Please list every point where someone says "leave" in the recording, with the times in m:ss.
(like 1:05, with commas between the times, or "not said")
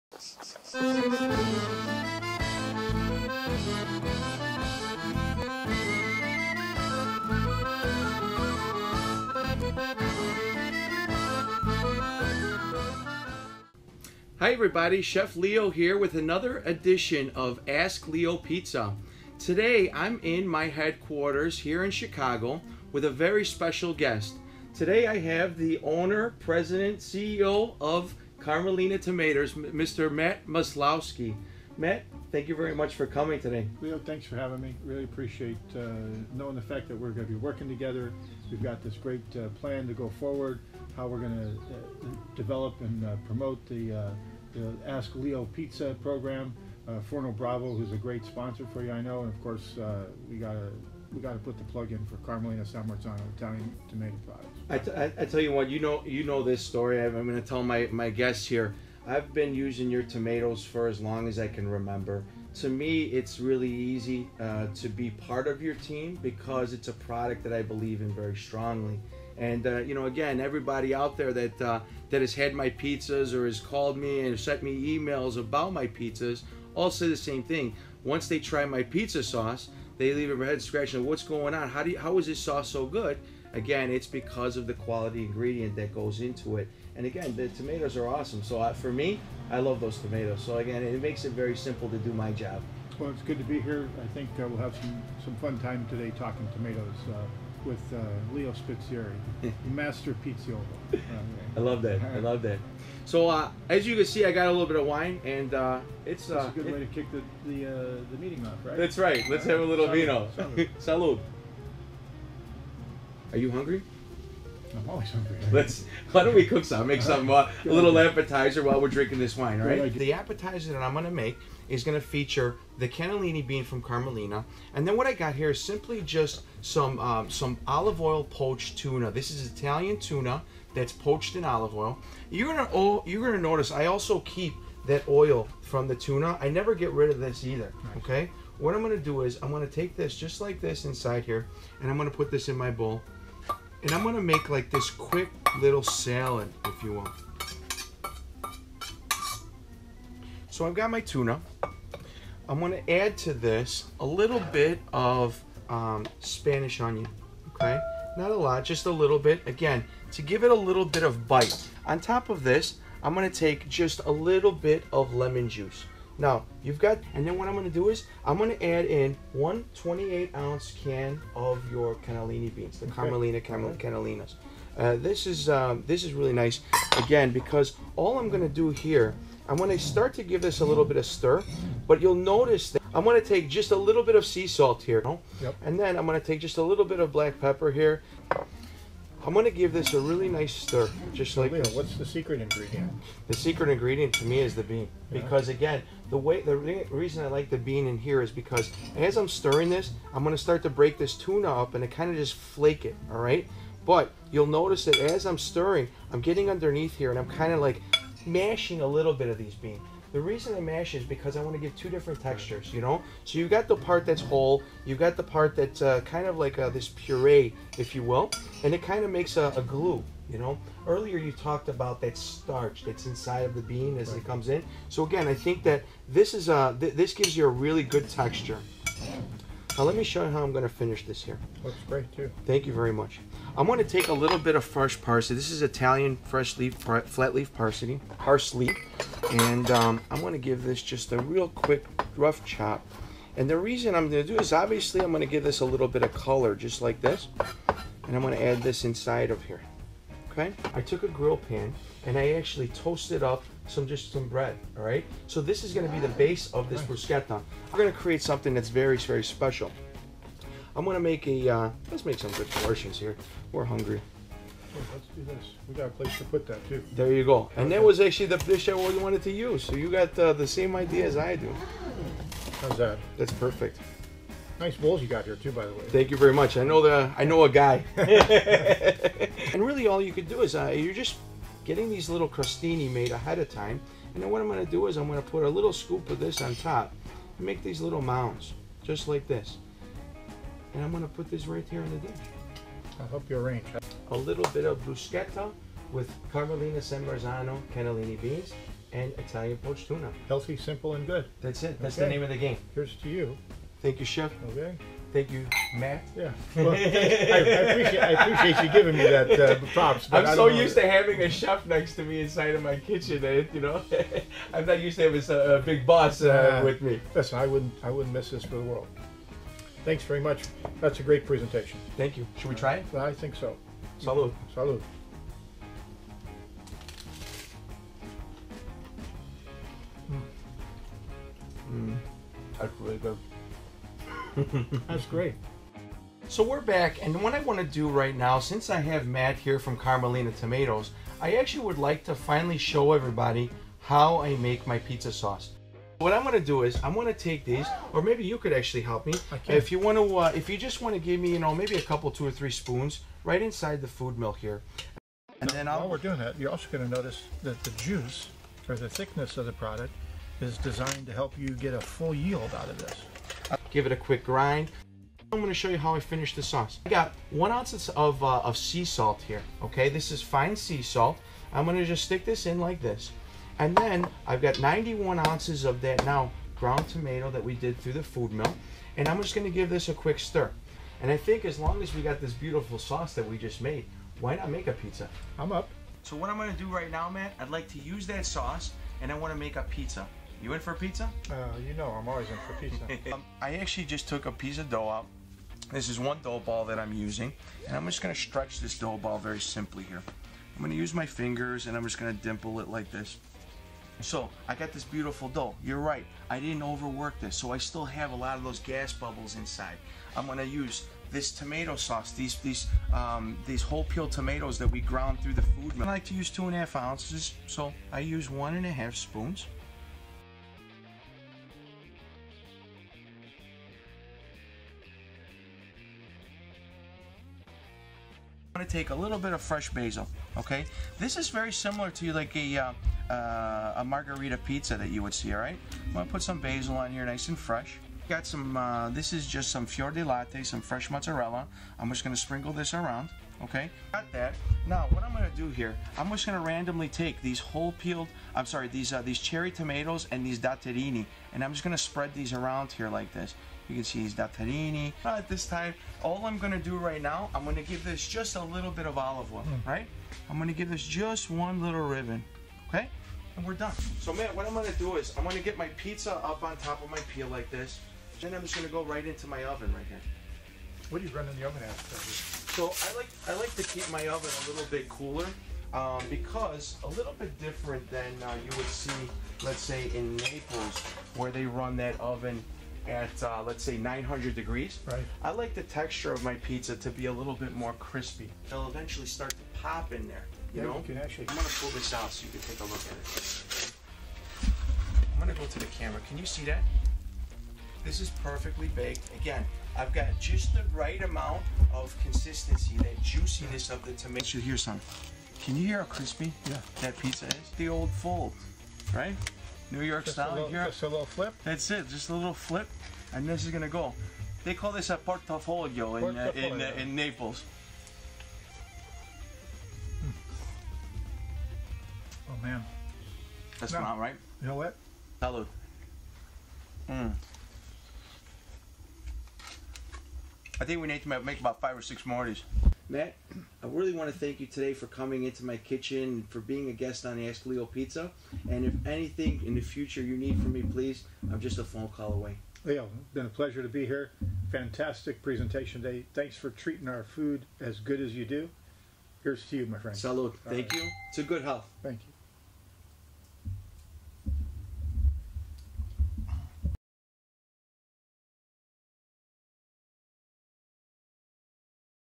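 1:20.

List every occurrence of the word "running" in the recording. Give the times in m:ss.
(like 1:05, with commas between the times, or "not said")
7:51.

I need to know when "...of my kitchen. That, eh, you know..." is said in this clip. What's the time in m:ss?
5:12.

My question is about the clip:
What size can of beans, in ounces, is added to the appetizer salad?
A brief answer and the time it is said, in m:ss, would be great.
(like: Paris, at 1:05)
28, at 2:49.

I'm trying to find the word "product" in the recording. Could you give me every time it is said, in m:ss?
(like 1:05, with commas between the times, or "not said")
0:54, 1:06, 5:59.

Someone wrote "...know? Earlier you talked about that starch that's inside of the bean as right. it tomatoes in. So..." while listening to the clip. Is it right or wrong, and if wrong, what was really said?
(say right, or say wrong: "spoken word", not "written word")
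wrong: "comes", not "tomatoes".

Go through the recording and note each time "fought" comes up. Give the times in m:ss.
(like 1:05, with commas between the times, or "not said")
not said.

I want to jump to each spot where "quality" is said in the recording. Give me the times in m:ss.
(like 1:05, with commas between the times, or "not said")
1:24.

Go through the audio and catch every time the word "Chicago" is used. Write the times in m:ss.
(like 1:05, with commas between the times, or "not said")
0:21.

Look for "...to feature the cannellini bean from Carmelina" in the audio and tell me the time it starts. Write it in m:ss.
2:01.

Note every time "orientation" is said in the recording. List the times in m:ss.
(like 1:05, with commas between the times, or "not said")
not said.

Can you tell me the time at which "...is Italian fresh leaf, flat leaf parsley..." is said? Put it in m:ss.
3:55.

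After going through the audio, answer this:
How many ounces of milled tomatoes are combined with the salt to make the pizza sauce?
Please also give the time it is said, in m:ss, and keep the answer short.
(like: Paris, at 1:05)
91, at 6:14.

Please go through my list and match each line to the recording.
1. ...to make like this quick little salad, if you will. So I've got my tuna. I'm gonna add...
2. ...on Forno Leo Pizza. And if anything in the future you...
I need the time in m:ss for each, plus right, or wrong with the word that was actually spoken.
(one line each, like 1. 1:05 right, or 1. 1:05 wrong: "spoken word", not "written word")
1. 2:24 right
2. 8:57 wrong: "Ask", not "Forno".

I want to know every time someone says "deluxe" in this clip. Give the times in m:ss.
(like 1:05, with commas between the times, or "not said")
not said.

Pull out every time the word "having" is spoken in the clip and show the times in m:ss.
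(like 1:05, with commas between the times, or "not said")
0:34, 5:10, 5:15.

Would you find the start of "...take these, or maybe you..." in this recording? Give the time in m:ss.
5:47.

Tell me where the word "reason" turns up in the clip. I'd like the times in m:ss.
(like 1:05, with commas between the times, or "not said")
3:16, 3:30, 4:03.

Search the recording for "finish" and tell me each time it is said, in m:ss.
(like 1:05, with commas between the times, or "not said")
3:50, 6:06.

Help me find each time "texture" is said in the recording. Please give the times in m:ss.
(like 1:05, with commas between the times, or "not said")
3:32, 3:48, 8:05.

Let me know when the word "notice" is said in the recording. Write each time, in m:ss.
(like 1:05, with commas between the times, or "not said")
2:13, 3:02, 3:24, 5:56.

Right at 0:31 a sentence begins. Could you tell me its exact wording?
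Matt, thank you very much for coming today.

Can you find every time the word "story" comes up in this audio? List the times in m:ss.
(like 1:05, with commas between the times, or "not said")
0:56.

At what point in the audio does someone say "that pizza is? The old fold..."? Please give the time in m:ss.
8:26.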